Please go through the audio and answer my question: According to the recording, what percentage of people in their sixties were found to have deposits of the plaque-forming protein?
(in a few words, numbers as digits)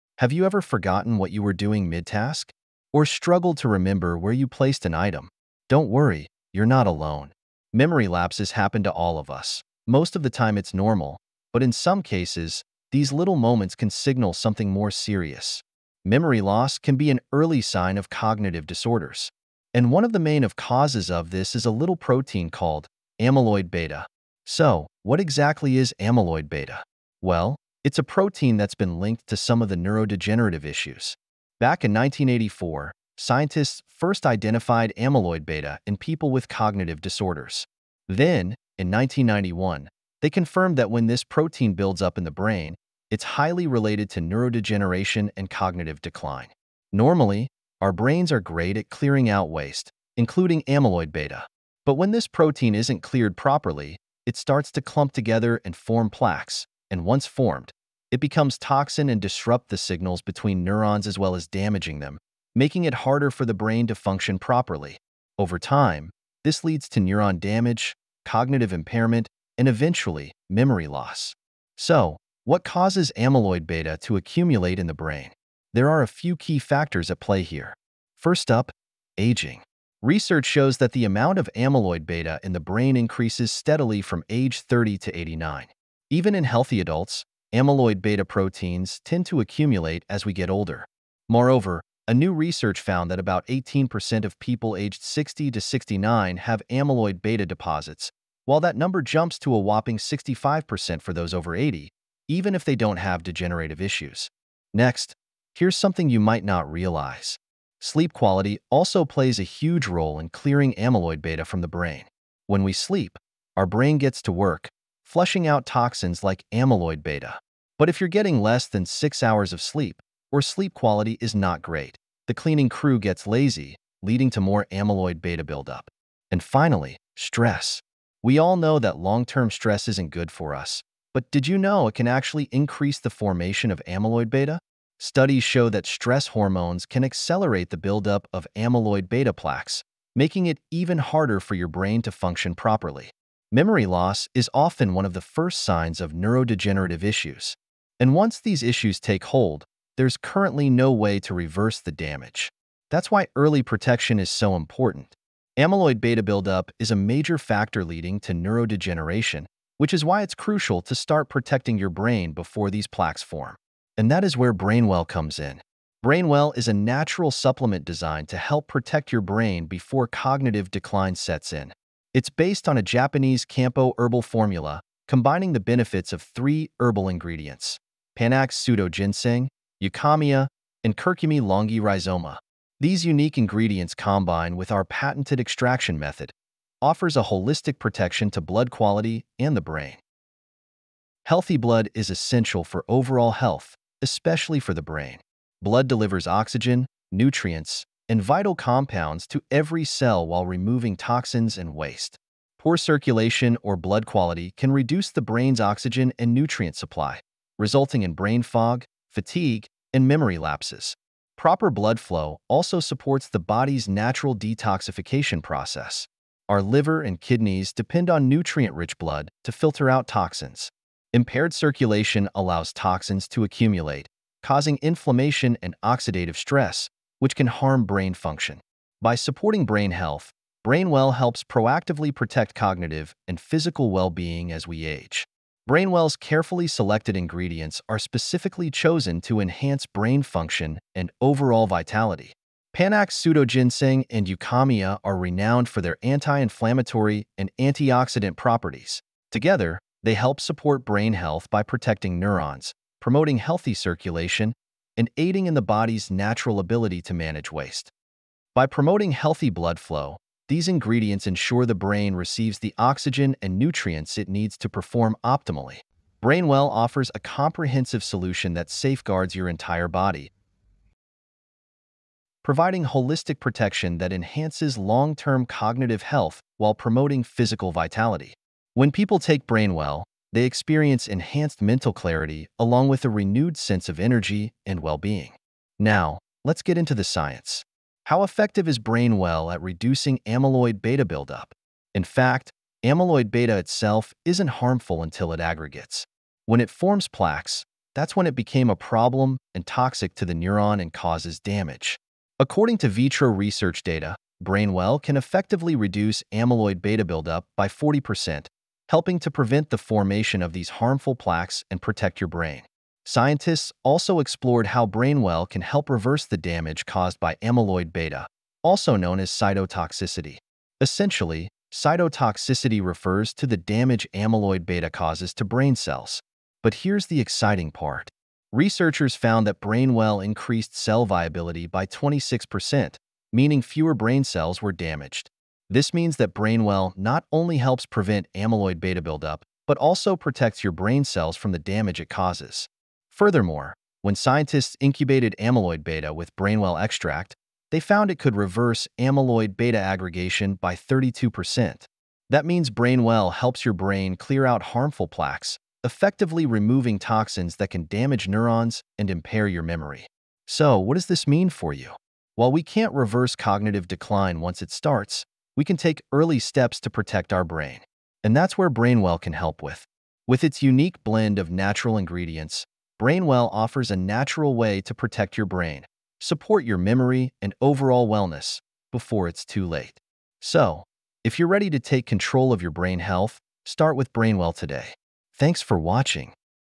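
18%.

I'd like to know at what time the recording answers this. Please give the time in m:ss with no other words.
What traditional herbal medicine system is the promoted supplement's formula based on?
2:52.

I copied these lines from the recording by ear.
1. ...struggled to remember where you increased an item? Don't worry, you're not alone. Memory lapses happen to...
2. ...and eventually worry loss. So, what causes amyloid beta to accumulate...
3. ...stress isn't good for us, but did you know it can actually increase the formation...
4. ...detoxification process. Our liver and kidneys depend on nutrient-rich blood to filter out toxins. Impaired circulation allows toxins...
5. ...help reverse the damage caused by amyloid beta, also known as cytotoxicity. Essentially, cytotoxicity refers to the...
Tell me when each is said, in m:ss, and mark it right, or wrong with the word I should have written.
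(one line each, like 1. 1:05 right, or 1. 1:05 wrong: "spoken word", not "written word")
1. 0:03 wrong: "placed", not "increased"
2. 1:09 wrong: "memory", not "worry"
3. 2:09 right
4. 3:34 right
5. 5:15 right.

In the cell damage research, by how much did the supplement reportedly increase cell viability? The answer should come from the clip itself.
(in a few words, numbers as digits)
26%.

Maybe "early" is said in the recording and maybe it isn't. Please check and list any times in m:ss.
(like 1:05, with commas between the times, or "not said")
0:17, 2:33, 6:06.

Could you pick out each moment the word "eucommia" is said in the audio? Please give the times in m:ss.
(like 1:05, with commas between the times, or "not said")
2:59, 4:04.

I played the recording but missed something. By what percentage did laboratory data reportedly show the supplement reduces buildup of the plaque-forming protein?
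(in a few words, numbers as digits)
40%.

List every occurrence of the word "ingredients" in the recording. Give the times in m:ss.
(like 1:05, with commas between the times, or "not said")
2:57, 3:03, 3:57, 4:20, 6:11.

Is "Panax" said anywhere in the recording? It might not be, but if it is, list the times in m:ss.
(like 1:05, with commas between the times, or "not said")
2:58, 4:02.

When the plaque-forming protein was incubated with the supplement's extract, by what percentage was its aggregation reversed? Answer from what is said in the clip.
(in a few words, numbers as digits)
32%.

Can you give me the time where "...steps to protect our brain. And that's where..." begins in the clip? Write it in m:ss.
6:06.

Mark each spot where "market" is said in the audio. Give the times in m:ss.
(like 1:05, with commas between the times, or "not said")
not said.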